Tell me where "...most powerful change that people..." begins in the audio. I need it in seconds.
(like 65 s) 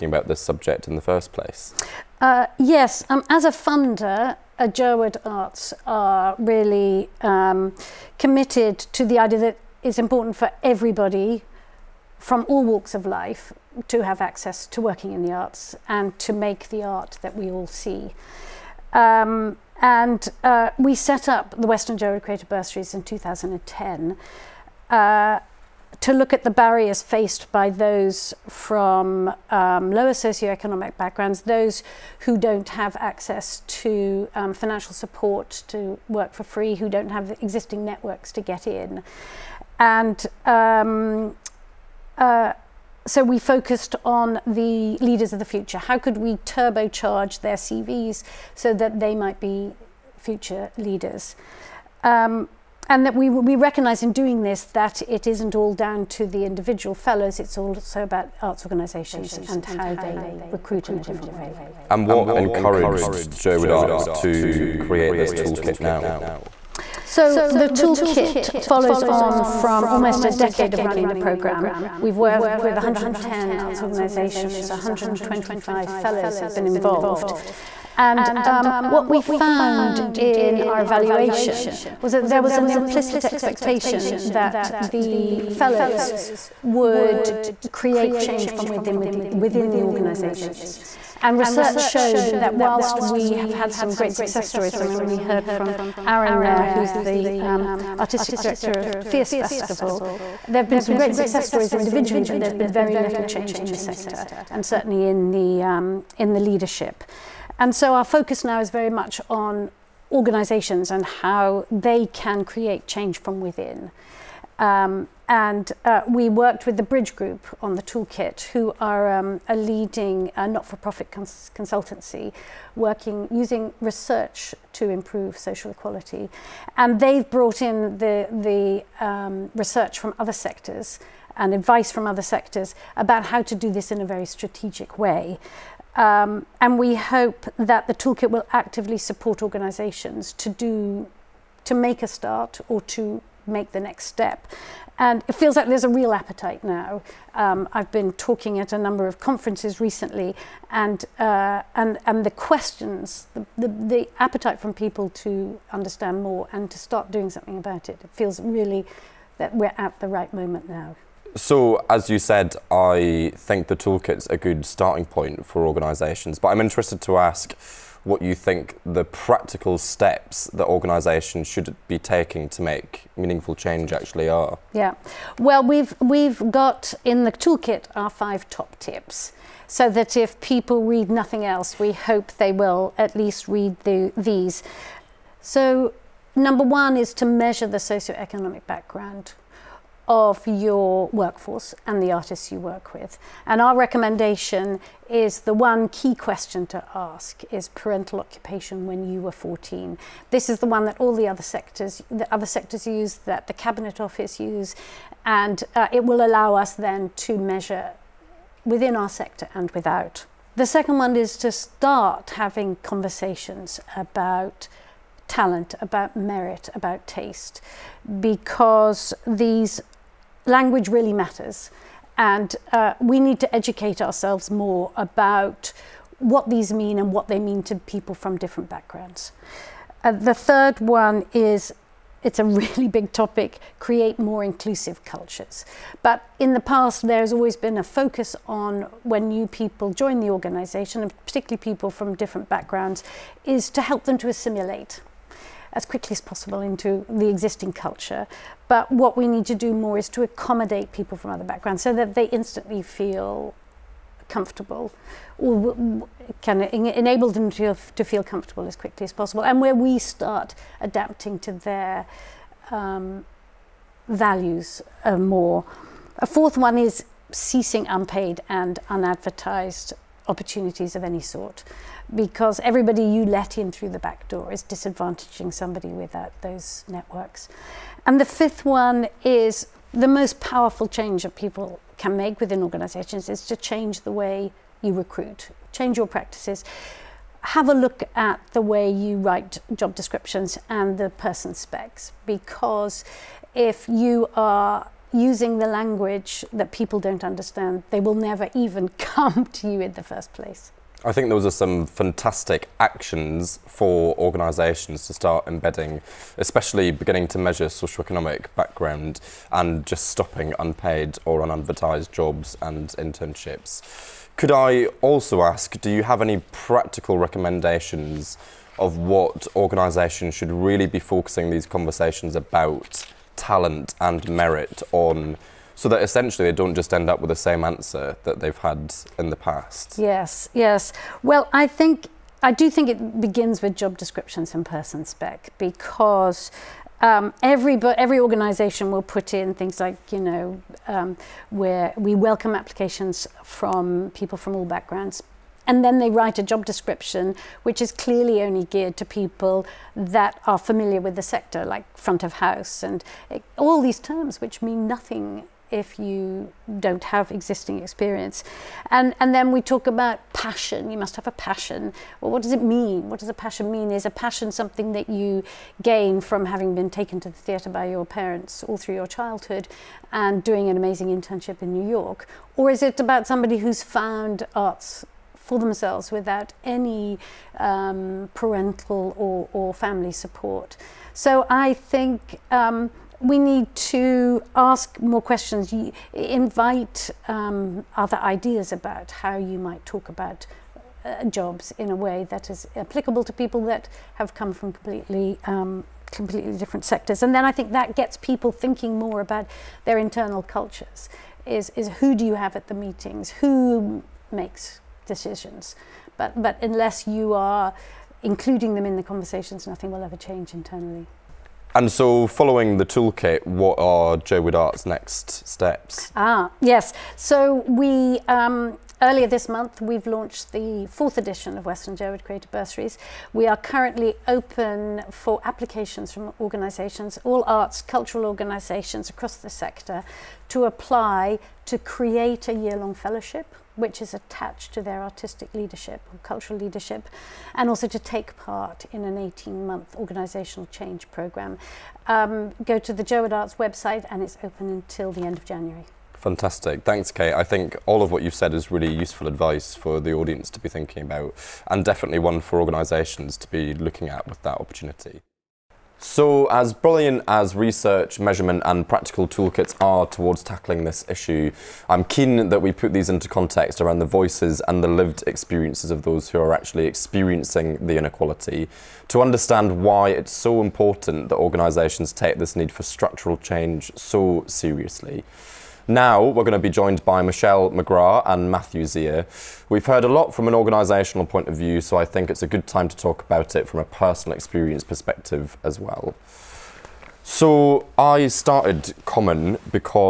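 280 s.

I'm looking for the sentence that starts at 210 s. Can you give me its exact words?
The second one is to start having conversations about talent, about merit, about taste, because these language really matters.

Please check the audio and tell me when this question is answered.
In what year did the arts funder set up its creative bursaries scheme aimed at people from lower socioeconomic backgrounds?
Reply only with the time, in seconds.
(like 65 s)
23 s.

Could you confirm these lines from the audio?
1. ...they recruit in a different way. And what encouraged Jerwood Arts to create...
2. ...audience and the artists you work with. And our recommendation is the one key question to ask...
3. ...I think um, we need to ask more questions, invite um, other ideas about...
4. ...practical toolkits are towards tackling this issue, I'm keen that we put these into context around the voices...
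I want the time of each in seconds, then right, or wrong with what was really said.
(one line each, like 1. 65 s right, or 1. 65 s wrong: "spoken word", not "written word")
1. 59 s right
2. 191 s wrong: "workforce", not "audience"
3. 381 s right
4. 458 s right.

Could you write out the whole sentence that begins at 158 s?
It feels really that we're at the right moment now.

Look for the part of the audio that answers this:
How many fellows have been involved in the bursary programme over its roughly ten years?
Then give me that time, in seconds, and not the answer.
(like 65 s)
74 s.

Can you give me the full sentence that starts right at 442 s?
Um, go to the Jerwood Arts website and it's open until the end of January.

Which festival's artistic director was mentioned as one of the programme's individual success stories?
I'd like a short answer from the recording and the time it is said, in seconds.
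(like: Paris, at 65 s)
Fierce Festival, at 99 s.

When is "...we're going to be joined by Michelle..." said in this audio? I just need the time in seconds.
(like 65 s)
476 s.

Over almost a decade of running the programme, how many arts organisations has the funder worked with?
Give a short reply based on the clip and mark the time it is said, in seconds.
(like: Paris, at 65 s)
110, at 72 s.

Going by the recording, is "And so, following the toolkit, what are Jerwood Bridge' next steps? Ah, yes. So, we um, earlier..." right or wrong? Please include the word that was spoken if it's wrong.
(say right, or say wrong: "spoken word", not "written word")
wrong: "Arts", not "Bridge".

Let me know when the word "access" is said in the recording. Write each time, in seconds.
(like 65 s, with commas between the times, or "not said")
14 s, 32 s.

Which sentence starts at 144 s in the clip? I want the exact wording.
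And it feels like there's a real appetite now.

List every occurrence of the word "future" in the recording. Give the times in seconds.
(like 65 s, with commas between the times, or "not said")
45 s, 50 s.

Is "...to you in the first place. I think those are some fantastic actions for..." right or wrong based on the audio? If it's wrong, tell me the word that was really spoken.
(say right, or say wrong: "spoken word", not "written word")
right.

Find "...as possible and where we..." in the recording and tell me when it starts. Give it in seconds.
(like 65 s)
259 s.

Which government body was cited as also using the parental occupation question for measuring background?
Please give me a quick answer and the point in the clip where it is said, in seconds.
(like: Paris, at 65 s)
Cabinet Office, at 203 s.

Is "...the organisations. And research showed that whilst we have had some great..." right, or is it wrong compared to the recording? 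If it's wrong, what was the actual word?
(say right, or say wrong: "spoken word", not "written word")
right.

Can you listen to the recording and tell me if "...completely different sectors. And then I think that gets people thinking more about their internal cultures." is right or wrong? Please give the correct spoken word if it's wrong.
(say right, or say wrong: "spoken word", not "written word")
right.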